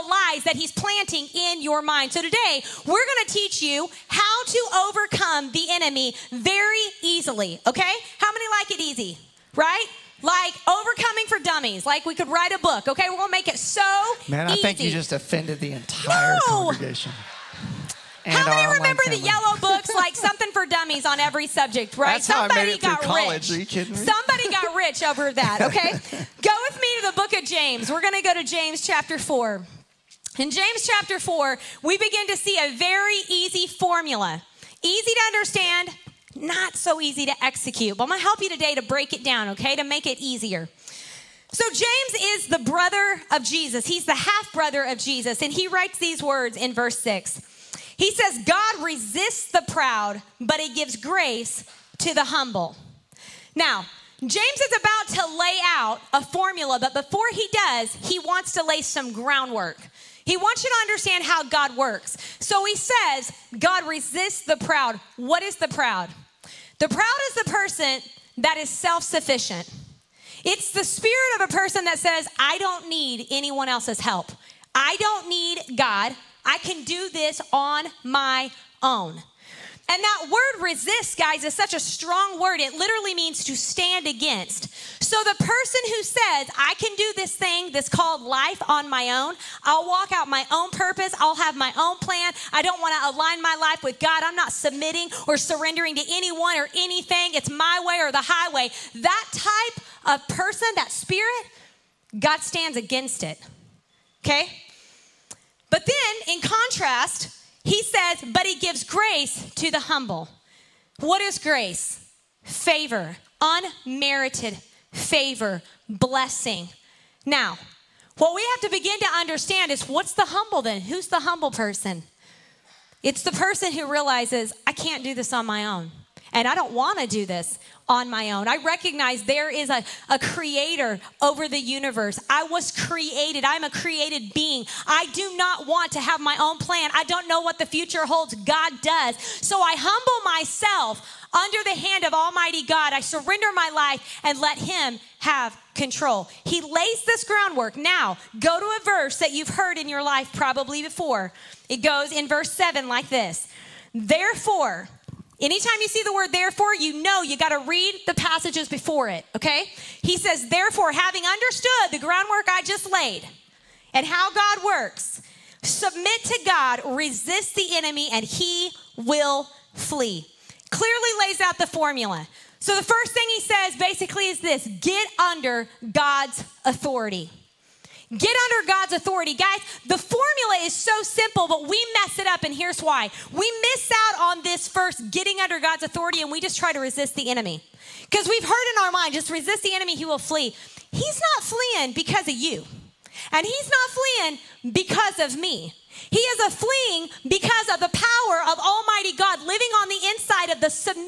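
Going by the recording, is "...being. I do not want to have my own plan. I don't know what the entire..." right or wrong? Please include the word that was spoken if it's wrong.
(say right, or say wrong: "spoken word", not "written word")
wrong: "future", not "entire".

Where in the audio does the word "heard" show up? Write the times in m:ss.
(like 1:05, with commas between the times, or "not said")
2:29, 3:08.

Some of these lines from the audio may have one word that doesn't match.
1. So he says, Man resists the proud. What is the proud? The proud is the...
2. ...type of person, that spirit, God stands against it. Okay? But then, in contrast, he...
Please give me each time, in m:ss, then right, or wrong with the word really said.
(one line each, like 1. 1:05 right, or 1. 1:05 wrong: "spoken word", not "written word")
1. 1:02 wrong: "God", not "Man"
2. 1:39 right.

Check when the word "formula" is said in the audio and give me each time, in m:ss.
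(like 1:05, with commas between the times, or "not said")
0:33, 0:56, 2:51, 2:59.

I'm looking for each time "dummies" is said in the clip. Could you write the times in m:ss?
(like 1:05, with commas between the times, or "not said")
0:11, 0:20.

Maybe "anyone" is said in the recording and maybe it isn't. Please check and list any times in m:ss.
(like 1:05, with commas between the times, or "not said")
1:13, 1:36.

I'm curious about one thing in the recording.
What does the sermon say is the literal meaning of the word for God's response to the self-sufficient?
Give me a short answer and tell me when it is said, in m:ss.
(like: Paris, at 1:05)
To stand against, at 1:23.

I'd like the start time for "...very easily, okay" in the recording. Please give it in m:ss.
0:06.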